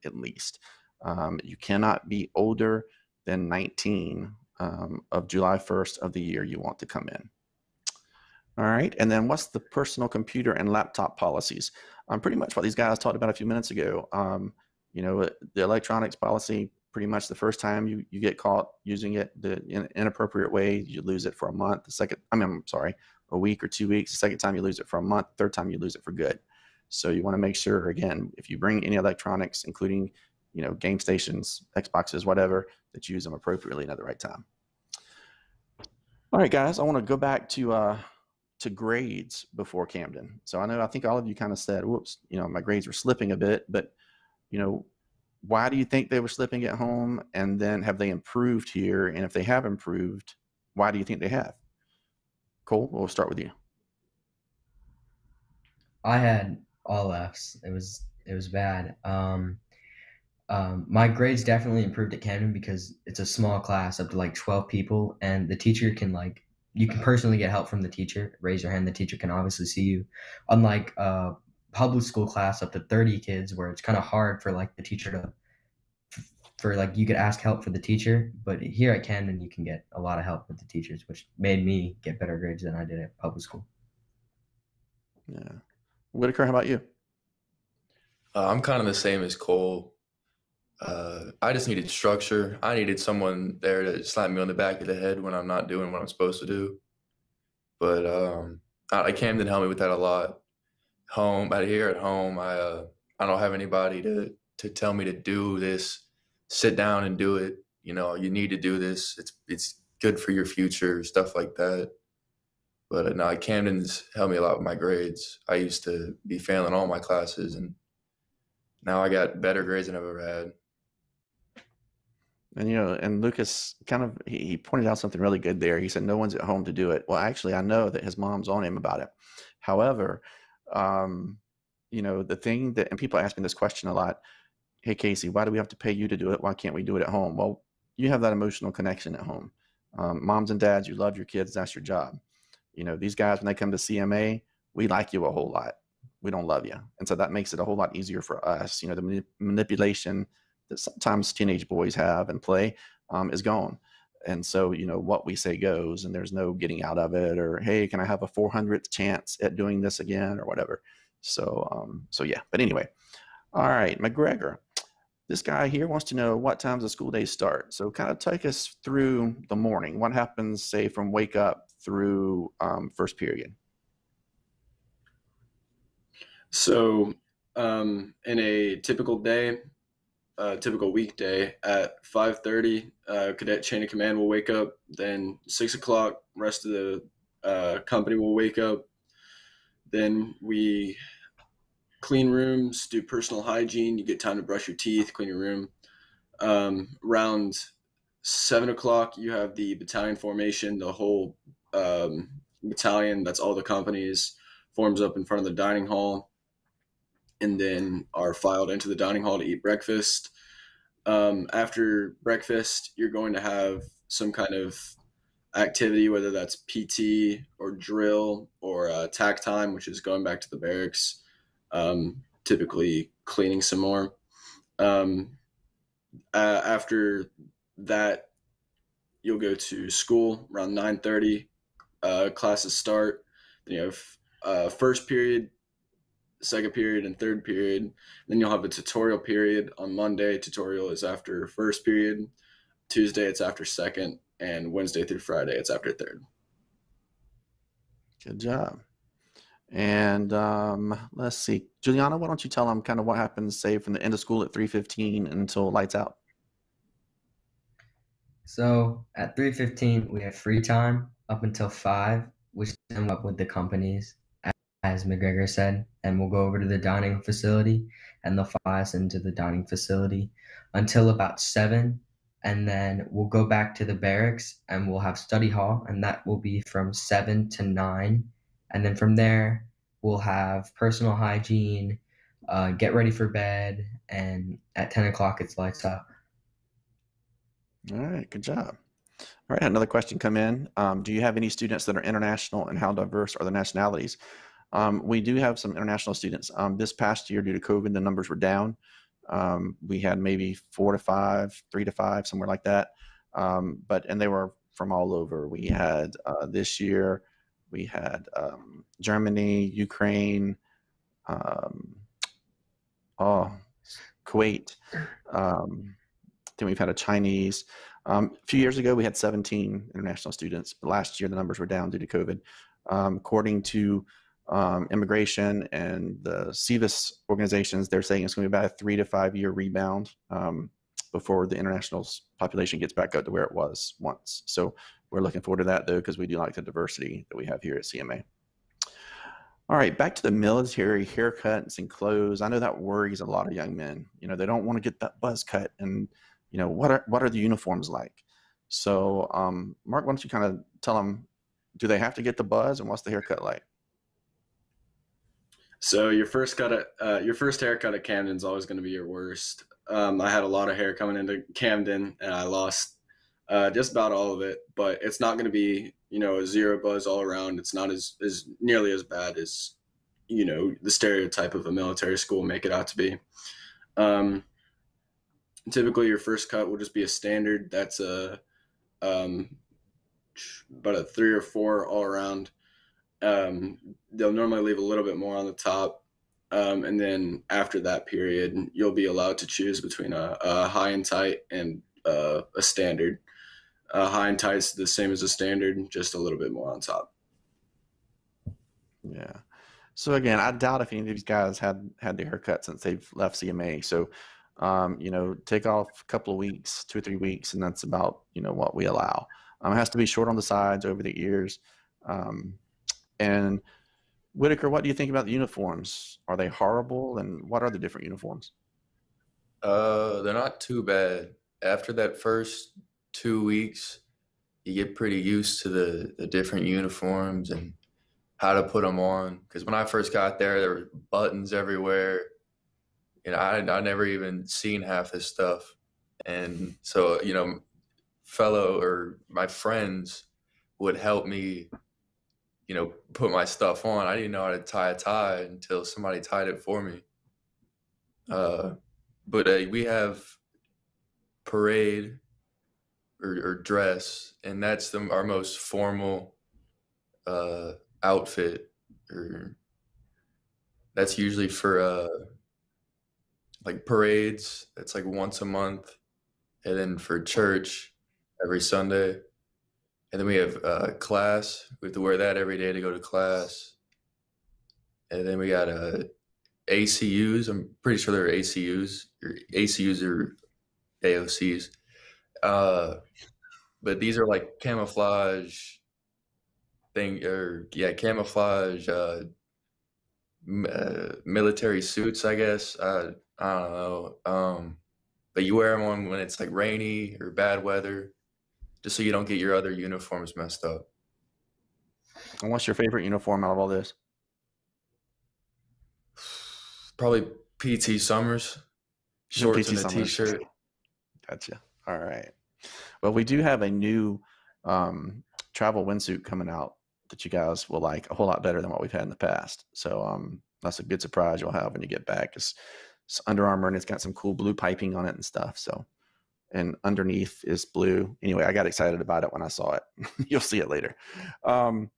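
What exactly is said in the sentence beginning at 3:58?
Then you'll have a tutorial period on Monday.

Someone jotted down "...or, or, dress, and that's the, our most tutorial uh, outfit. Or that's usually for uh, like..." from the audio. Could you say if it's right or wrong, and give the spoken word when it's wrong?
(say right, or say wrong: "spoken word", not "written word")
wrong: "formal", not "tutorial".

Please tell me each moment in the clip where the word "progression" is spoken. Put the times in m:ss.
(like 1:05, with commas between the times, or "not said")
not said.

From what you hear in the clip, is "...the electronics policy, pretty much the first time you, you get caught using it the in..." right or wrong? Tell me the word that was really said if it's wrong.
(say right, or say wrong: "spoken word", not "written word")
right.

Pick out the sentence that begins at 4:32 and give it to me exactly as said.
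And then we'll go back to the barracks and we'll have study hall, and that will be from seven to nine.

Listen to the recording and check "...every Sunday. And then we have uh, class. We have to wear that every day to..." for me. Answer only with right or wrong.
right.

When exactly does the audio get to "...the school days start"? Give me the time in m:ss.
2:46.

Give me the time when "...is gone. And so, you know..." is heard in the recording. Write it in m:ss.
2:33.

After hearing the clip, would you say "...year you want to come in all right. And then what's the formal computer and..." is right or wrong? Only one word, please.
wrong.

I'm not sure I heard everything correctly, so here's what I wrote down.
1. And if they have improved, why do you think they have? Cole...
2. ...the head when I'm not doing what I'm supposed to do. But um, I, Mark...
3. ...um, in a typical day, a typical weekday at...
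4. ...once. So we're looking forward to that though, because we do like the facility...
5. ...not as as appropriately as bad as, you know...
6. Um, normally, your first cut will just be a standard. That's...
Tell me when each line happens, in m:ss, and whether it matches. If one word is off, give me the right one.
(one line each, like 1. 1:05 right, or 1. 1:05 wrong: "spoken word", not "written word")
1. 0:49 right
2. 1:34 wrong: "Camden", not "Mark"
3. 2:57 right
4. 5:33 wrong: "diversity", not "facility"
5. 6:07 wrong: "nearly", not "appropriately"
6. 6:13 wrong: "typically", not "normally".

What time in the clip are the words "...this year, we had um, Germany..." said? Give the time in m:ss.
5:06.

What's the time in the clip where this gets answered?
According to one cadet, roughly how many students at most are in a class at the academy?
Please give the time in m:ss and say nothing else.
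1:03.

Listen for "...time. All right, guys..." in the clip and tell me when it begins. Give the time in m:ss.
0:34.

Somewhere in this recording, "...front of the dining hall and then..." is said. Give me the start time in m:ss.
3:25.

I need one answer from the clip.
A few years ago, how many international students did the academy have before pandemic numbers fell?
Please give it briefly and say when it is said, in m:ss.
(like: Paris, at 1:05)
17, at 5:19.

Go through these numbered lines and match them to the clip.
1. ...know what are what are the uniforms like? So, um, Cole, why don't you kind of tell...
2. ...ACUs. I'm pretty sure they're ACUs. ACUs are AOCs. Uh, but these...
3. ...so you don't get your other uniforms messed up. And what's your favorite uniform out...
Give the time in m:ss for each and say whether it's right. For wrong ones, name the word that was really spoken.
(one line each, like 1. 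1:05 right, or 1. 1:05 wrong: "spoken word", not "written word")
1. 5:46 wrong: "Mark", not "Cole"
2. 7:56 right
3. 8:18 right.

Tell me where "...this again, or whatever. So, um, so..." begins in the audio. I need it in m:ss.
2:39.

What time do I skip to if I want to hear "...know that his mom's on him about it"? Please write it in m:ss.
2:07.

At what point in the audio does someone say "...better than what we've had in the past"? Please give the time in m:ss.
8:38.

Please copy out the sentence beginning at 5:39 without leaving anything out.
All right, back to the military haircuts and clothes.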